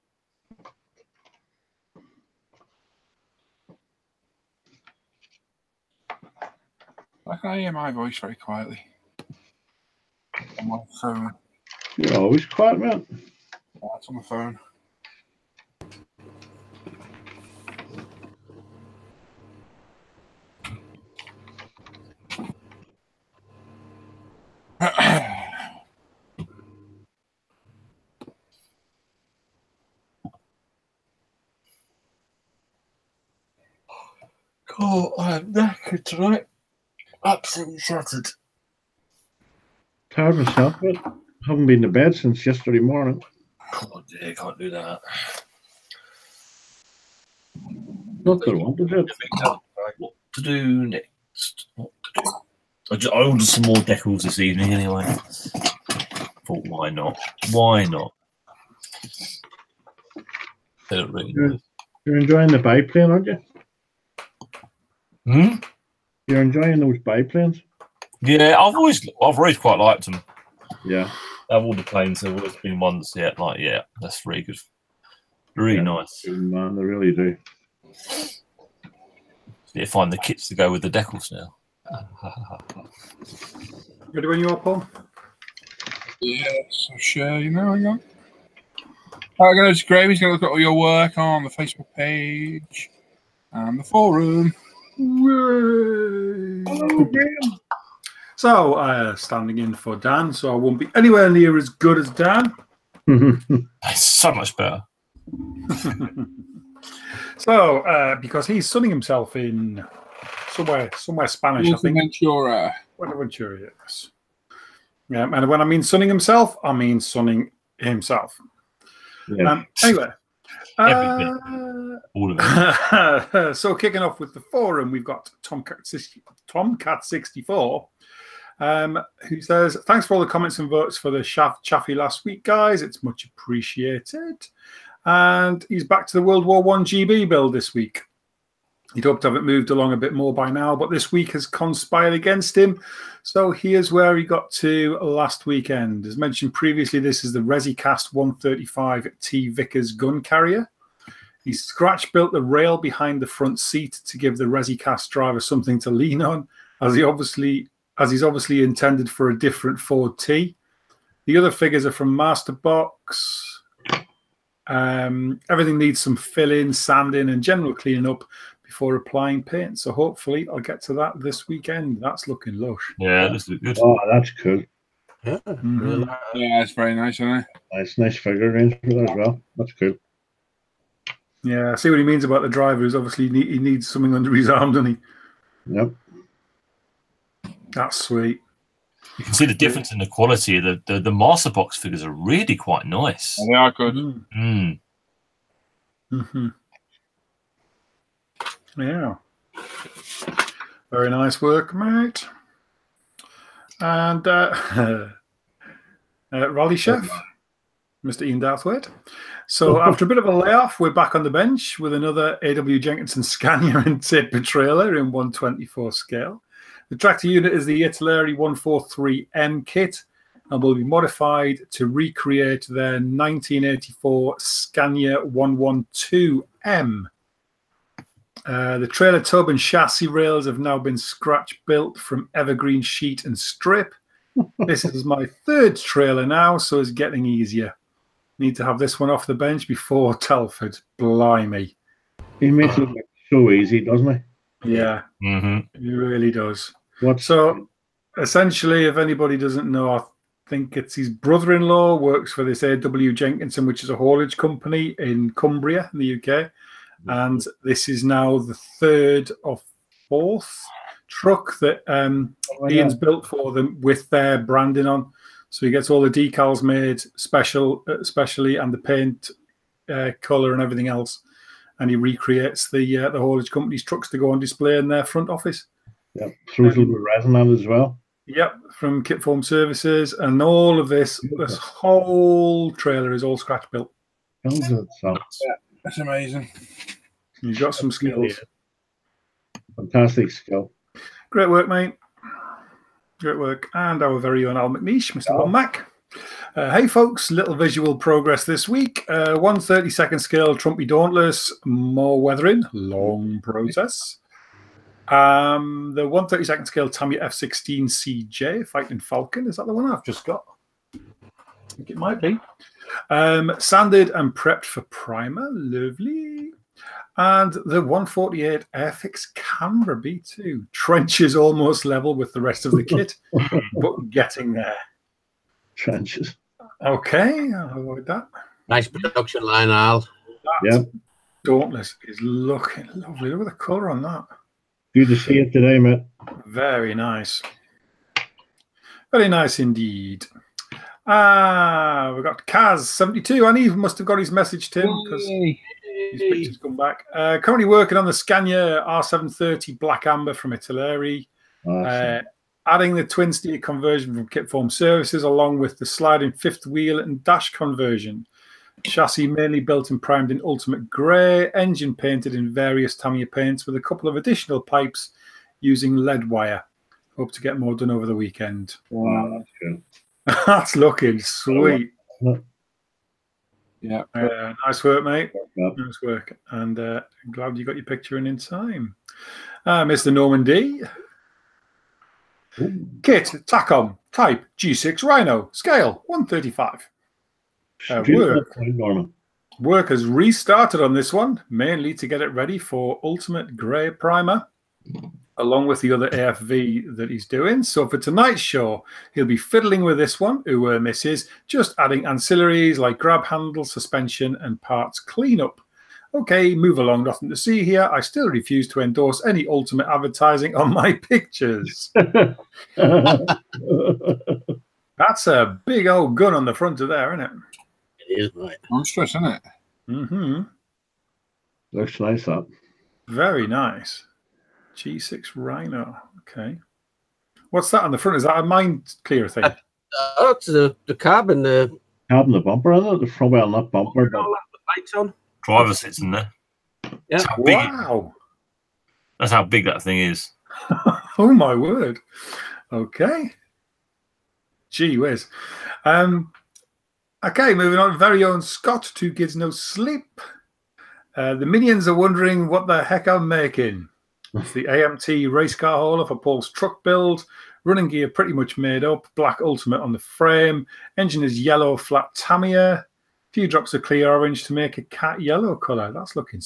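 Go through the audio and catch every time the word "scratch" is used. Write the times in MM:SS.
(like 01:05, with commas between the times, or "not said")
02:31, 03:50, 04:43.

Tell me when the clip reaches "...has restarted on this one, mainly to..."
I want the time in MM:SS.
06:29.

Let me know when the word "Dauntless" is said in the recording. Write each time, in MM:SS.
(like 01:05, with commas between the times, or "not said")
05:00, 05:31.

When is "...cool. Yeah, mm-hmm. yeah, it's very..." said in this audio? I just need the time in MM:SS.
02:54.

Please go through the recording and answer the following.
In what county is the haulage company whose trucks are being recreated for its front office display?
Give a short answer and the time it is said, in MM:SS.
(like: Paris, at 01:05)
Cumbria, at 04:15.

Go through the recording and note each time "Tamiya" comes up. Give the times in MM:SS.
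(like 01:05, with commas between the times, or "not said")
05:06, 06:02, 07:42.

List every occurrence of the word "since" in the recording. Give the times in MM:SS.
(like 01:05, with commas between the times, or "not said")
00:42.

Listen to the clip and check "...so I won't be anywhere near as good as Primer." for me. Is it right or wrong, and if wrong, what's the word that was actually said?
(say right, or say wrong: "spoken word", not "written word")
wrong: "Dan", not "Primer".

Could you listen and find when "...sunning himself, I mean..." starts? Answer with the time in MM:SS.
01:55.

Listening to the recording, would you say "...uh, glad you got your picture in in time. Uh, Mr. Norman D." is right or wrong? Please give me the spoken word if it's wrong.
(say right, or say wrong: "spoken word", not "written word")
right.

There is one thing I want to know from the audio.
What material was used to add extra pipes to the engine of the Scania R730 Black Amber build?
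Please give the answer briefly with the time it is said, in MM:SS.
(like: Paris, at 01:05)
Lead wire, at 06:05.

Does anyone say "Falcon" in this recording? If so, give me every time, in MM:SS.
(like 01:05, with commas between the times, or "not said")
05:08.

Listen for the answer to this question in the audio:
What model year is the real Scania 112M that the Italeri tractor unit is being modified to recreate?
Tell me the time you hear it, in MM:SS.
03:42.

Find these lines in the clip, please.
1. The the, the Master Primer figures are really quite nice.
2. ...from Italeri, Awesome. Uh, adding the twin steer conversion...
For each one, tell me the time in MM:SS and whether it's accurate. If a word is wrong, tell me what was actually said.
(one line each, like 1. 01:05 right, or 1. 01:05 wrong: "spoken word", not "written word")
1. 03:10 wrong: "Box", not "Primer"
2. 05:50 right.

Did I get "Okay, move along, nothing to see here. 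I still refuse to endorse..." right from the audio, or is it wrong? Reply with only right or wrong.
right.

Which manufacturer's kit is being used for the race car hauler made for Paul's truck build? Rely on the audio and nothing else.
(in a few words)
AMT.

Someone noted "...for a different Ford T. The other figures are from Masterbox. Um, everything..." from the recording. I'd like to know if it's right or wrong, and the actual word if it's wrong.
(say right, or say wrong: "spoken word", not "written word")
right.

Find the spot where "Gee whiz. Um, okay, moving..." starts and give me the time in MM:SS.
07:24.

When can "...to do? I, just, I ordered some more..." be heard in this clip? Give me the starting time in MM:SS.
00:52.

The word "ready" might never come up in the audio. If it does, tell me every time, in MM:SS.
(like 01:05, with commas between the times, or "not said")
01:24, 06:32.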